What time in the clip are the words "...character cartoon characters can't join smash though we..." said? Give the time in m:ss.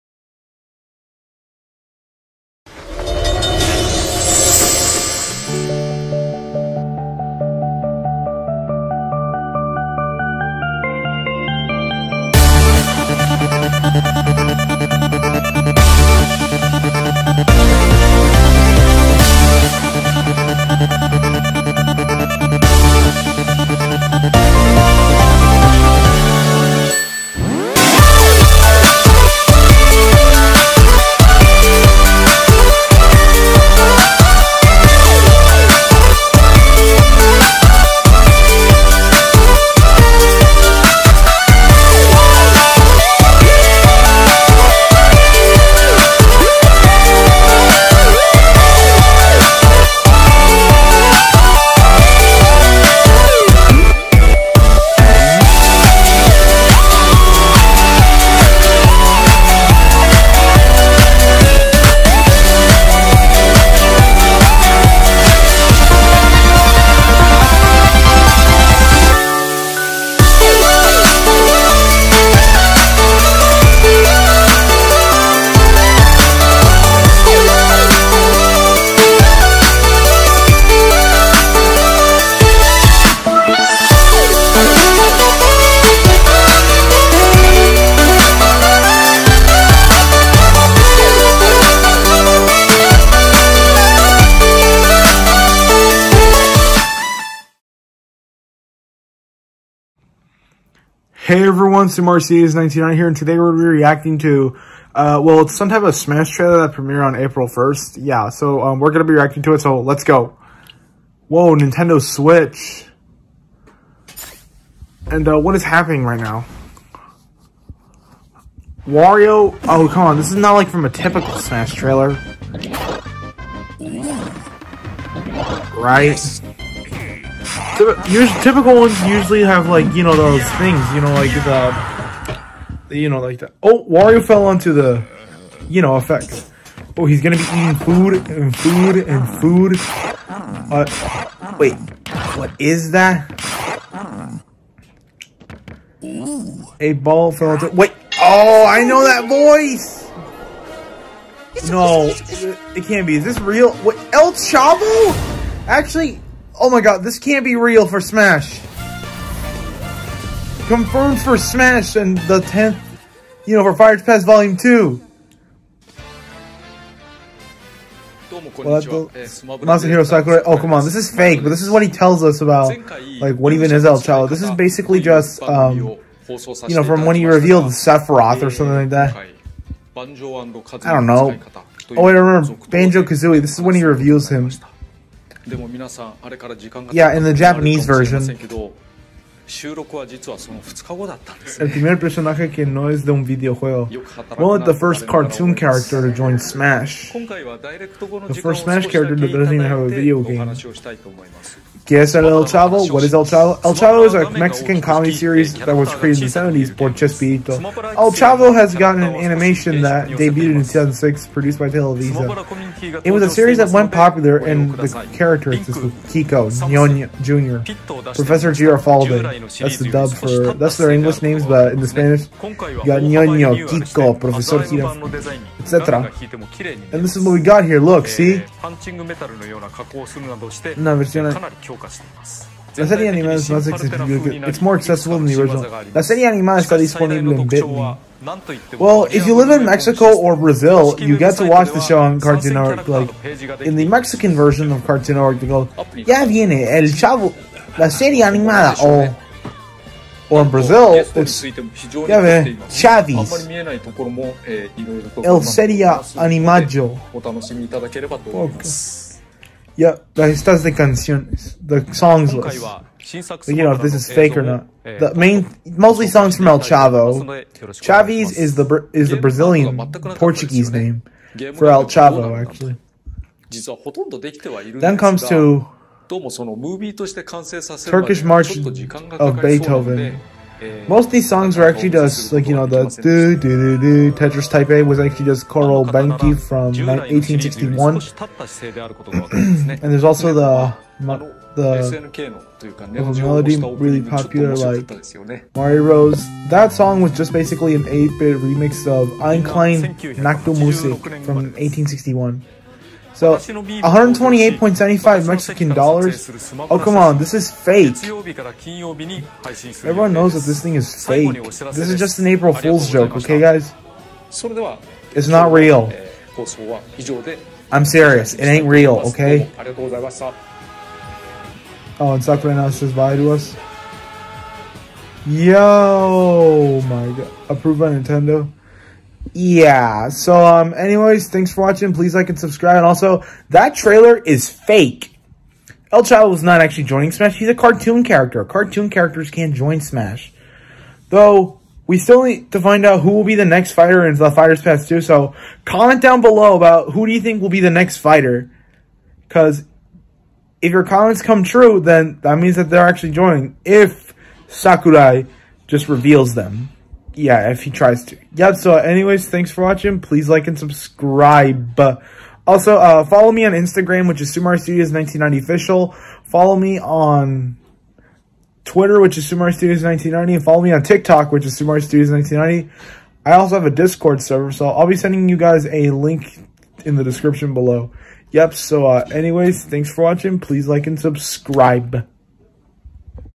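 5:38.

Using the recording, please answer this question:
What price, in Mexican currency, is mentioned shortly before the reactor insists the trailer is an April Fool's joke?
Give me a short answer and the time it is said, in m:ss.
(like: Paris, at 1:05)
128.75 Mexican dollars, at 5:03.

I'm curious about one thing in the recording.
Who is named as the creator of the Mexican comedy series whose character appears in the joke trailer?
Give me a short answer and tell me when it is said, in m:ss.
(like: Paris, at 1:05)
Chespirito, at 3:26.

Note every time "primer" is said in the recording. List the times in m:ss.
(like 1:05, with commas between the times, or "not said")
3:11.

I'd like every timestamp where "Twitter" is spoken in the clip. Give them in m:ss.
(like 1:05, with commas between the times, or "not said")
6:08.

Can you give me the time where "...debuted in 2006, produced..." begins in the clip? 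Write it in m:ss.
3:30.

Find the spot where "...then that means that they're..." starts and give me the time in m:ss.
5:51.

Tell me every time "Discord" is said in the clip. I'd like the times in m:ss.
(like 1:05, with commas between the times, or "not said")
6:13.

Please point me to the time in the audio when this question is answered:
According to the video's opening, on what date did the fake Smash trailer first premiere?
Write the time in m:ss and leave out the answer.
1:47.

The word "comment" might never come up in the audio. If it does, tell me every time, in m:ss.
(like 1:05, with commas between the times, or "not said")
5:45, 5:50.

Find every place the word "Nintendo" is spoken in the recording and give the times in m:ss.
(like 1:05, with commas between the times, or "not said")
1:51, 5:27.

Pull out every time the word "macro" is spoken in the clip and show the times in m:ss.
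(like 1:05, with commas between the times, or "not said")
not said.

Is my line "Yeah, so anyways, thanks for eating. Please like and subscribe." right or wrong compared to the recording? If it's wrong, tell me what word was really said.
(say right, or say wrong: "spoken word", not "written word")
wrong: "watching", not "eating".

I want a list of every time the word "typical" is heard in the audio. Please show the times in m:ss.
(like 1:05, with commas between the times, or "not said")
2:00, 2:07.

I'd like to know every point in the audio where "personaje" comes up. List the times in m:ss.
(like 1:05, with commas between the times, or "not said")
3:11.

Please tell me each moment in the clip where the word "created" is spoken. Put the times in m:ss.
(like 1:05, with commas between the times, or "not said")
3:25.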